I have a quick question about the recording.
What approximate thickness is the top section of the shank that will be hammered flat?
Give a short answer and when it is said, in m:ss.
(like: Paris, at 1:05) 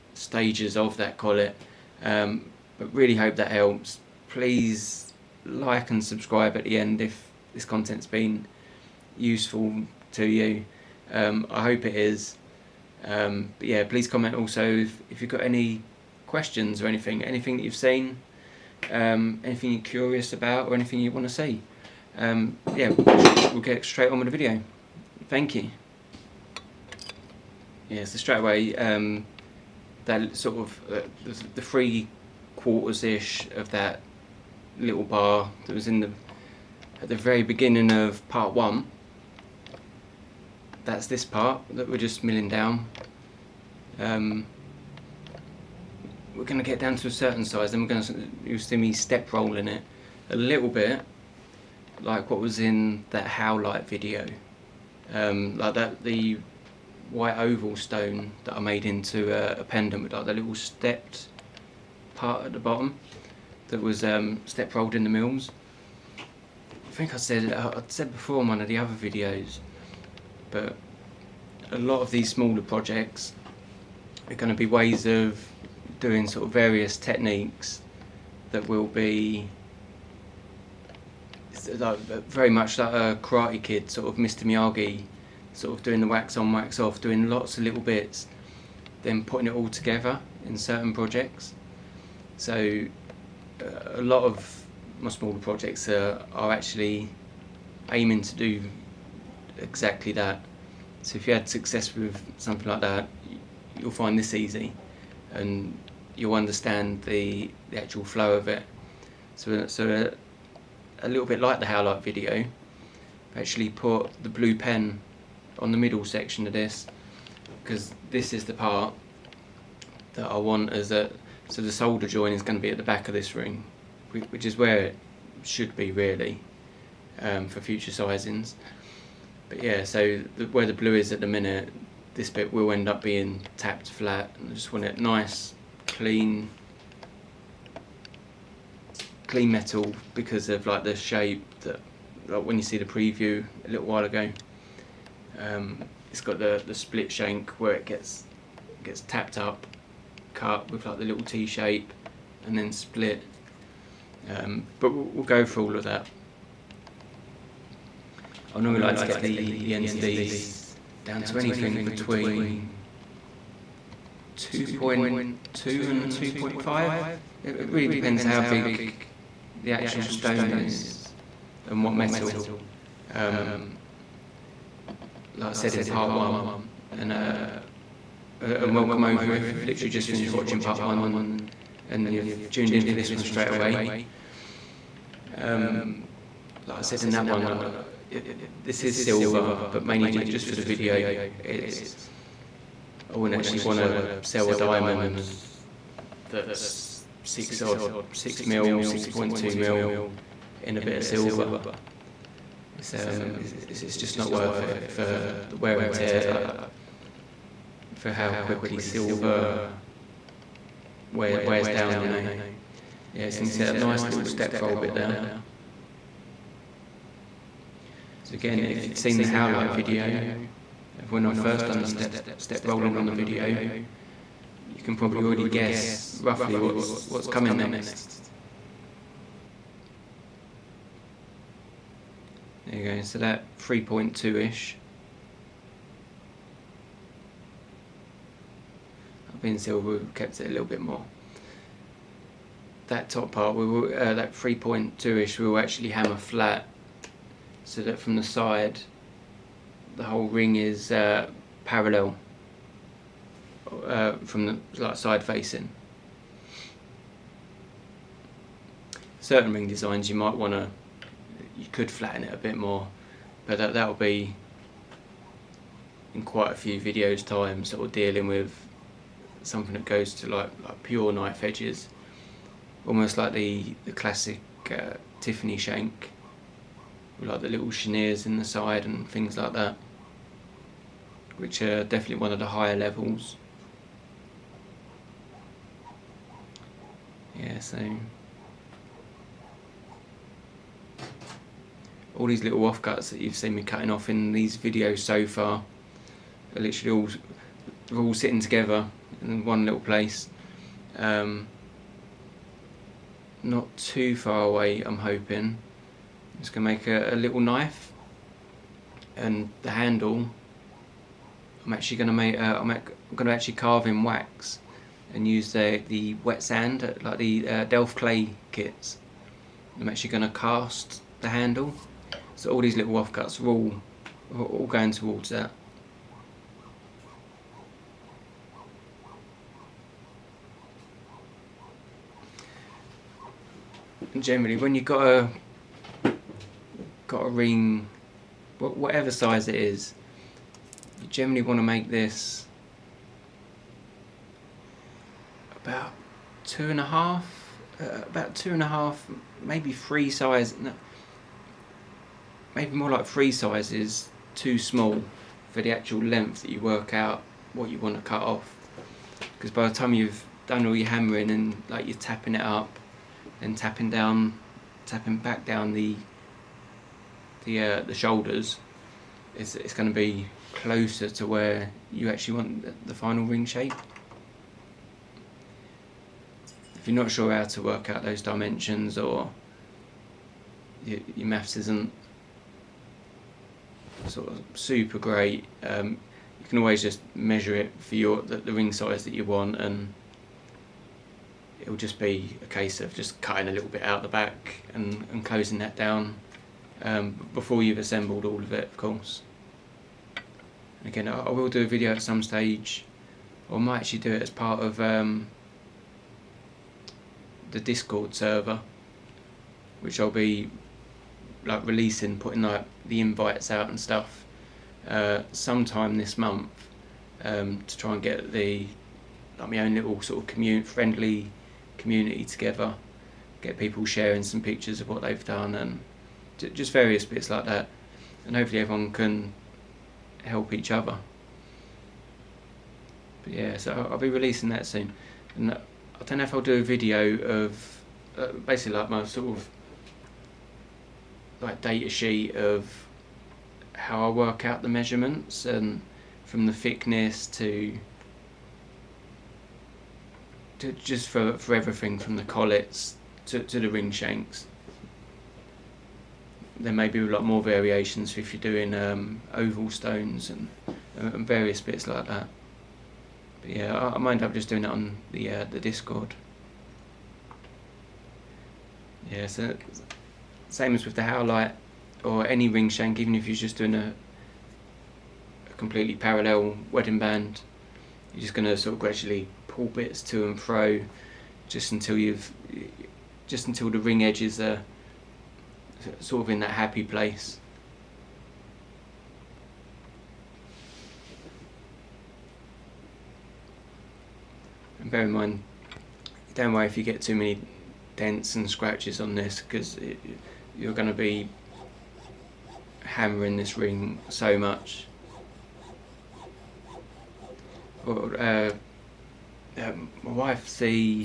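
3.2, at 3:53.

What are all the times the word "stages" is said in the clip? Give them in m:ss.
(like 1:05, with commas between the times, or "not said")
0:00, 6:42.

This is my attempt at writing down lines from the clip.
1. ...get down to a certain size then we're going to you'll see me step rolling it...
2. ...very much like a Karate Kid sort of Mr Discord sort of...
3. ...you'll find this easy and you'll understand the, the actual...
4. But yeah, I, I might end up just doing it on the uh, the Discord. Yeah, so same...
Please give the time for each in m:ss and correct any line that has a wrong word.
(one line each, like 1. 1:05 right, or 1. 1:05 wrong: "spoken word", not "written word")
1. 0:46 right
2. 1:21 wrong: "Miyagi", not "Discord"
3. 1:43 right
4. 7:43 right.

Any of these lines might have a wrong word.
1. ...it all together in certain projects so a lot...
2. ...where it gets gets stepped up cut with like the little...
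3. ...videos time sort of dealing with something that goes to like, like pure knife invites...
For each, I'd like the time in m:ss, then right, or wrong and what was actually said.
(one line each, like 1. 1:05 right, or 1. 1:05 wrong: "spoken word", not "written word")
1. 1:29 right
2. 2:27 wrong: "tapped", not "stepped"
3. 4:26 wrong: "edges", not "invites".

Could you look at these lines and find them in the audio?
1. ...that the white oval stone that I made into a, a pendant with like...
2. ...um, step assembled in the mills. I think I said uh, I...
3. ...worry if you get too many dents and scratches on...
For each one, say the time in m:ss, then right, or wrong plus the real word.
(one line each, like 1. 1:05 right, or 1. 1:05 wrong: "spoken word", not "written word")
1. 0:55 right
2. 1:04 wrong: "rolled", not "assembled"
3. 8:16 right.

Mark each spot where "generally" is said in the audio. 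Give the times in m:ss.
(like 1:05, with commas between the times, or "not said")
5:34, 5:41.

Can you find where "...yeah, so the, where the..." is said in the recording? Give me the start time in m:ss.
2:09.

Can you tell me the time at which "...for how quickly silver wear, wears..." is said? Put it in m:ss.
3:27.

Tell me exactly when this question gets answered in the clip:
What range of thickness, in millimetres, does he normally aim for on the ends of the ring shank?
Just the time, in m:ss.
2:44.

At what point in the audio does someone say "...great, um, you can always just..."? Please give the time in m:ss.
6:24.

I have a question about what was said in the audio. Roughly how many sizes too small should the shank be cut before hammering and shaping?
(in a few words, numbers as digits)
3.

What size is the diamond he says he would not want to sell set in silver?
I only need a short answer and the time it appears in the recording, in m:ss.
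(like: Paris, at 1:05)
6.2 mm, at 3:18.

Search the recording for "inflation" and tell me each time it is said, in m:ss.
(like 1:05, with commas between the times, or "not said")
not said.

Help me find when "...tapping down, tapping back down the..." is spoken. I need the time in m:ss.
6:03.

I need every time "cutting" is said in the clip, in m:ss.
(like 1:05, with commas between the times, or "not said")
4:53, 6:33.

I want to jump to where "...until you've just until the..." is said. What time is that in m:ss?
8:01.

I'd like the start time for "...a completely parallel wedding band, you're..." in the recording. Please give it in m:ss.
7:55.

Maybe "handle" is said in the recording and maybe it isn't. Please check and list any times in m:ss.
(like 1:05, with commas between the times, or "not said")
5:09, 5:21.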